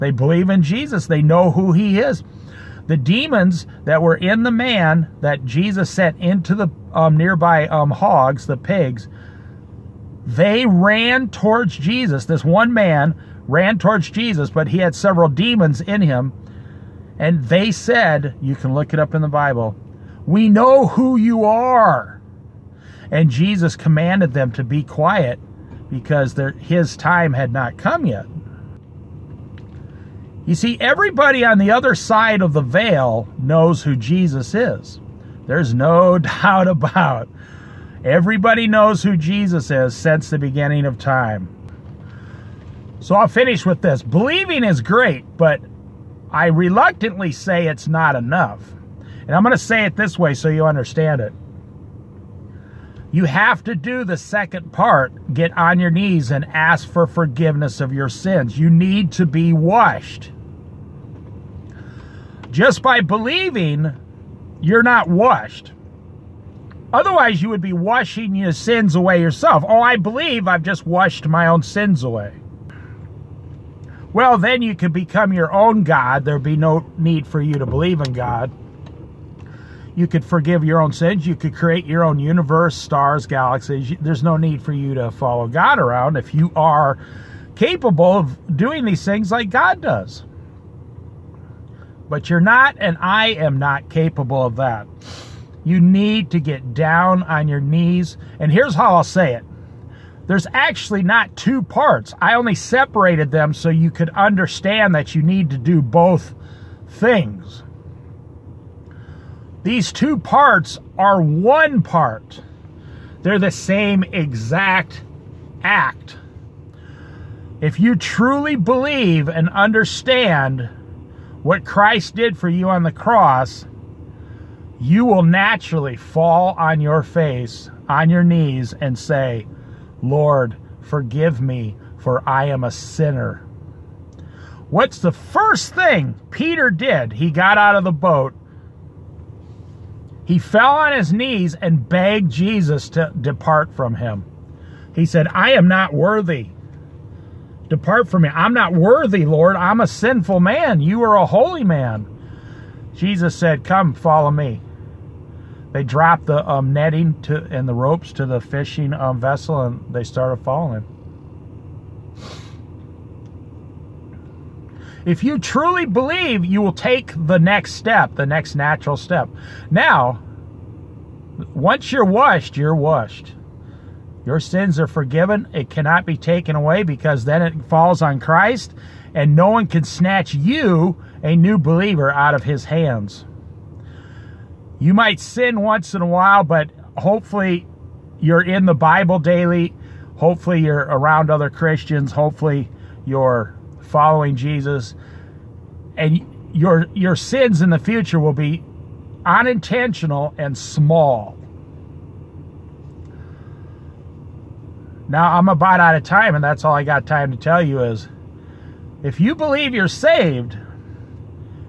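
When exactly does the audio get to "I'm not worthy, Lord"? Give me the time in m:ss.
2:28.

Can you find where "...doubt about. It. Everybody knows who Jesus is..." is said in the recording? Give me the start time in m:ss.
0:36.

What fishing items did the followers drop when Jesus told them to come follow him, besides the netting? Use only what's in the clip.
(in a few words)
The ropes.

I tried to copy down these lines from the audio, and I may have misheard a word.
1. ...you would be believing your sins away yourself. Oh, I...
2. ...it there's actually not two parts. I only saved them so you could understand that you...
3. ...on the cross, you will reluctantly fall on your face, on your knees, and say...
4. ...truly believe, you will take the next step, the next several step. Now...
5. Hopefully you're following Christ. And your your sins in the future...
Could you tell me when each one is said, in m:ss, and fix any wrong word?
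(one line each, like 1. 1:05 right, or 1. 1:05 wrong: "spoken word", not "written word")
1. 1:07 wrong: "washing", not "believing"
2. 1:39 wrong: "separated", not "saved"
3. 2:02 wrong: "naturally", not "reluctantly"
4. 2:45 wrong: "natural", not "several"
5. 3:12 wrong: "Jesus", not "Christ".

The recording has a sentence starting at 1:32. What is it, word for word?
But you're not, and I am not capable of that.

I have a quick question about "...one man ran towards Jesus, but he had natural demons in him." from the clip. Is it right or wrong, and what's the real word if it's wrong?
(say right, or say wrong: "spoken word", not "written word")
wrong: "several", not "natural".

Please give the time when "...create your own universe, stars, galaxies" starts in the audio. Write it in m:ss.
1:21.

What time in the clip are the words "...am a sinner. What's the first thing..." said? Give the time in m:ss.
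2:12.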